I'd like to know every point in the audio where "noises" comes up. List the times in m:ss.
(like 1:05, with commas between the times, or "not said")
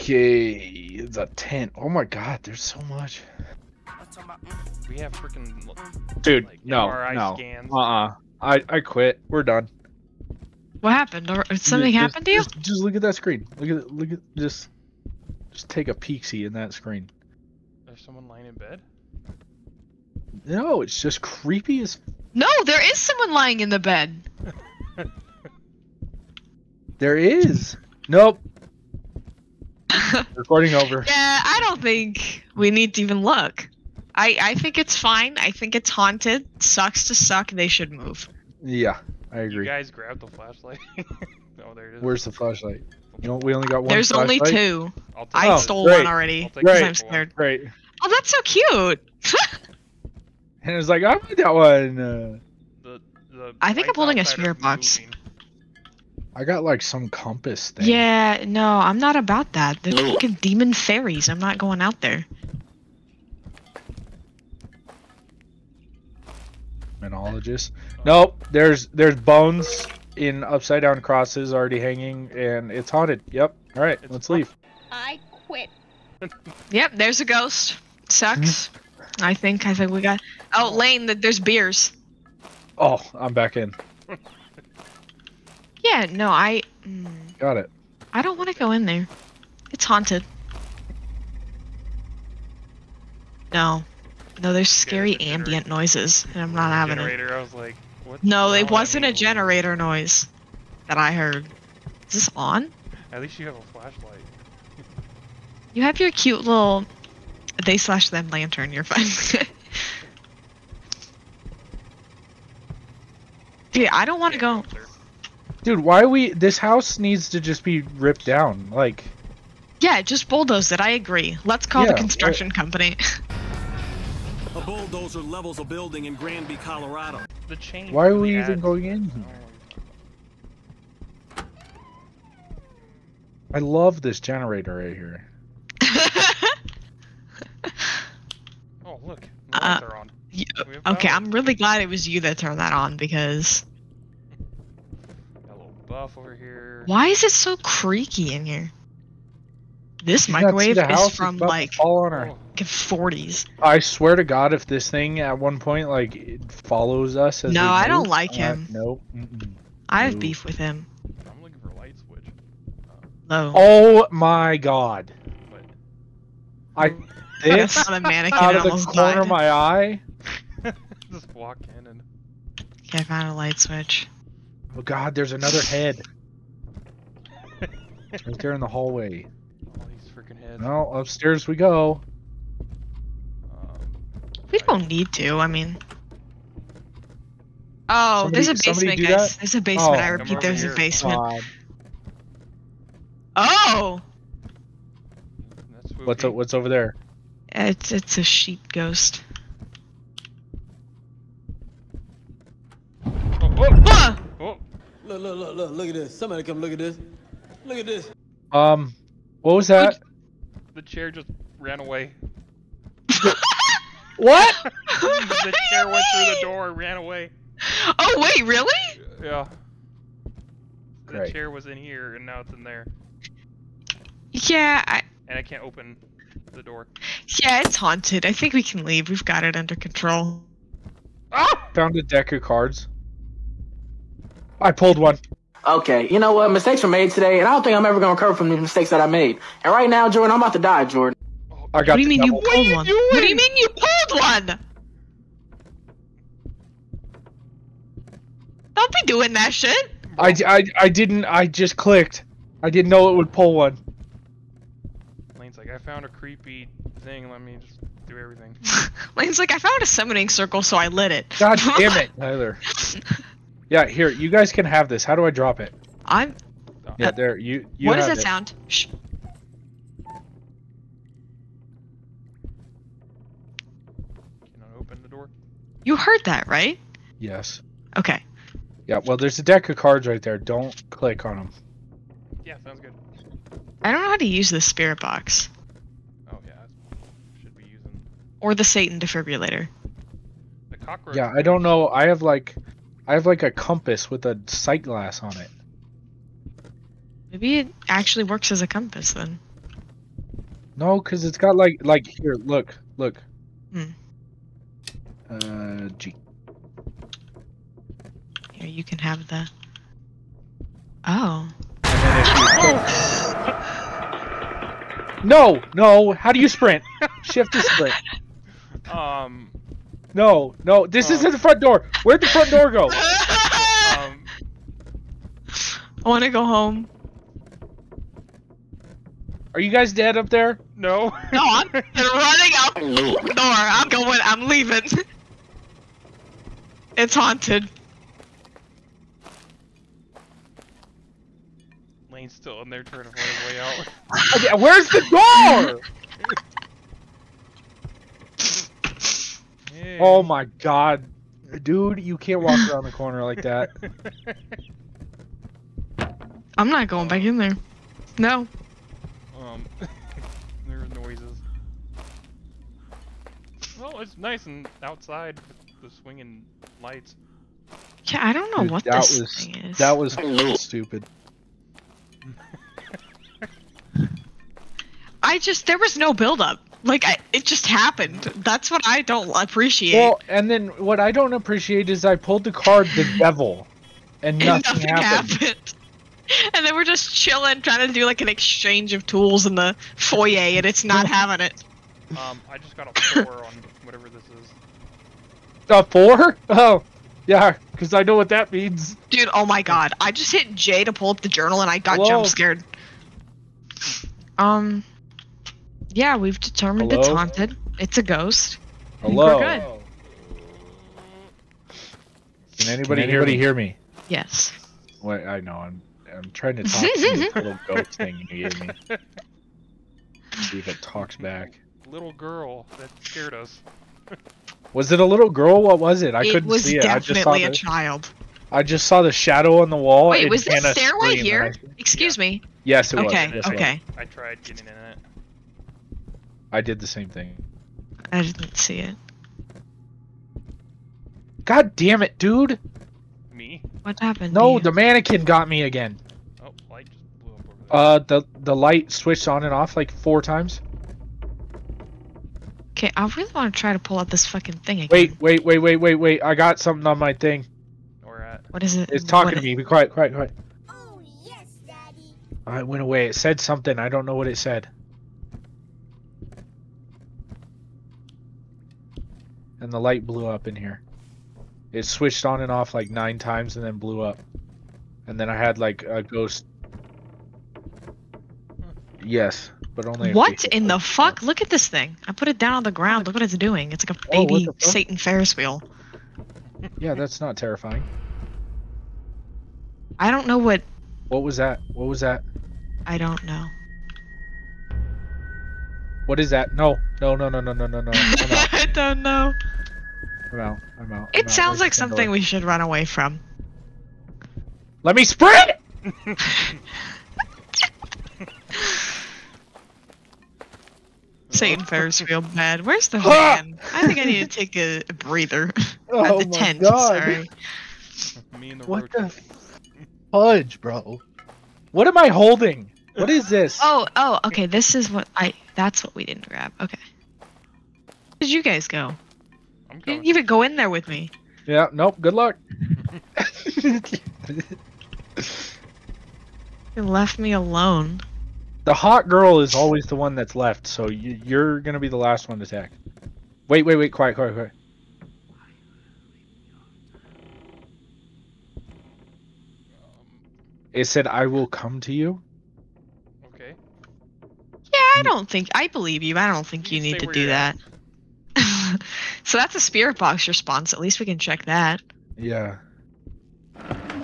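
1:35, 1:39, 6:00.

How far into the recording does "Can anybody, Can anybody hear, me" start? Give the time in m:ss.
6:52.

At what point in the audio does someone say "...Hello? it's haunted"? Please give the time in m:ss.
6:46.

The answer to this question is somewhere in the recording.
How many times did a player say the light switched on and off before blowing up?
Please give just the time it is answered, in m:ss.
7:52.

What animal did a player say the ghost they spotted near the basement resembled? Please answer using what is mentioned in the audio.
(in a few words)
Sheep.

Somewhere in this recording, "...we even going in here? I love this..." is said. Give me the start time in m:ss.
2:08.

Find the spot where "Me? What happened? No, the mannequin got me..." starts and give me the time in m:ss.
7:23.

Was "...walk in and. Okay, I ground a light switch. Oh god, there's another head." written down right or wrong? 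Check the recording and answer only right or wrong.
wrong.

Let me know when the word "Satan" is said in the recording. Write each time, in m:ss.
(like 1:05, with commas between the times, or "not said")
4:48, 8:04, 8:31.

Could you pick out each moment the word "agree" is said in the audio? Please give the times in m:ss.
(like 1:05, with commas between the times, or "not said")
0:39, 2:00.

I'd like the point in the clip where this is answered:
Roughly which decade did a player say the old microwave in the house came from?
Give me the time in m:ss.
2:31.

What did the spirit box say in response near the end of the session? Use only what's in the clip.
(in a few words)
I will come to you.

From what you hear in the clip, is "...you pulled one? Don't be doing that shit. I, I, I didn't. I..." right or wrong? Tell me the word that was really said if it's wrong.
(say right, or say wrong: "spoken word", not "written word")
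right.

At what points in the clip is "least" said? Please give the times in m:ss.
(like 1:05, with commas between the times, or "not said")
1:43, 9:20.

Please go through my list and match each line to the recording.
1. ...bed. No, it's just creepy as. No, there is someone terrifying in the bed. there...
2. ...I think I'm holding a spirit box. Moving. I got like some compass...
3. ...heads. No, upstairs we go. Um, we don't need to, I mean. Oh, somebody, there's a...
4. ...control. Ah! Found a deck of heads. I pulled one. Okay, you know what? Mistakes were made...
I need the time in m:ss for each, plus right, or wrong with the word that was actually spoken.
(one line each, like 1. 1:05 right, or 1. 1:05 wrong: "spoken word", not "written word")
1. 0:18 wrong: "lying", not "terrifying"
2. 0:53 right
3. 3:00 right
4. 3:49 wrong: "cards", not "heads".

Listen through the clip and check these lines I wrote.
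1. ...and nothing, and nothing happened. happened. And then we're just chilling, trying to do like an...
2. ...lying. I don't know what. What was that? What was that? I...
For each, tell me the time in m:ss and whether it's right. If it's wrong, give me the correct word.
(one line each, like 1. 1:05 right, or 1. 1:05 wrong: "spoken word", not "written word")
1. 6:24 right
2. 8:07 wrong: "terrifying", not "lying".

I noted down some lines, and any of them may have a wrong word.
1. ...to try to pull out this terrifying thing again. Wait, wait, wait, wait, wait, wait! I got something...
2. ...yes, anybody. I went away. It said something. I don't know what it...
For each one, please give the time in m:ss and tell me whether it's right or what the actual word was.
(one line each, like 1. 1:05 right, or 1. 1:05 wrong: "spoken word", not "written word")
1. 7:33 wrong: "fucking", not "terrifying"
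2. 7:41 wrong: "daddy", not "anybody".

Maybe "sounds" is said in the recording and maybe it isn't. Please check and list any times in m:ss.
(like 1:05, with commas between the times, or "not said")
4:28, 4:42, 8:21.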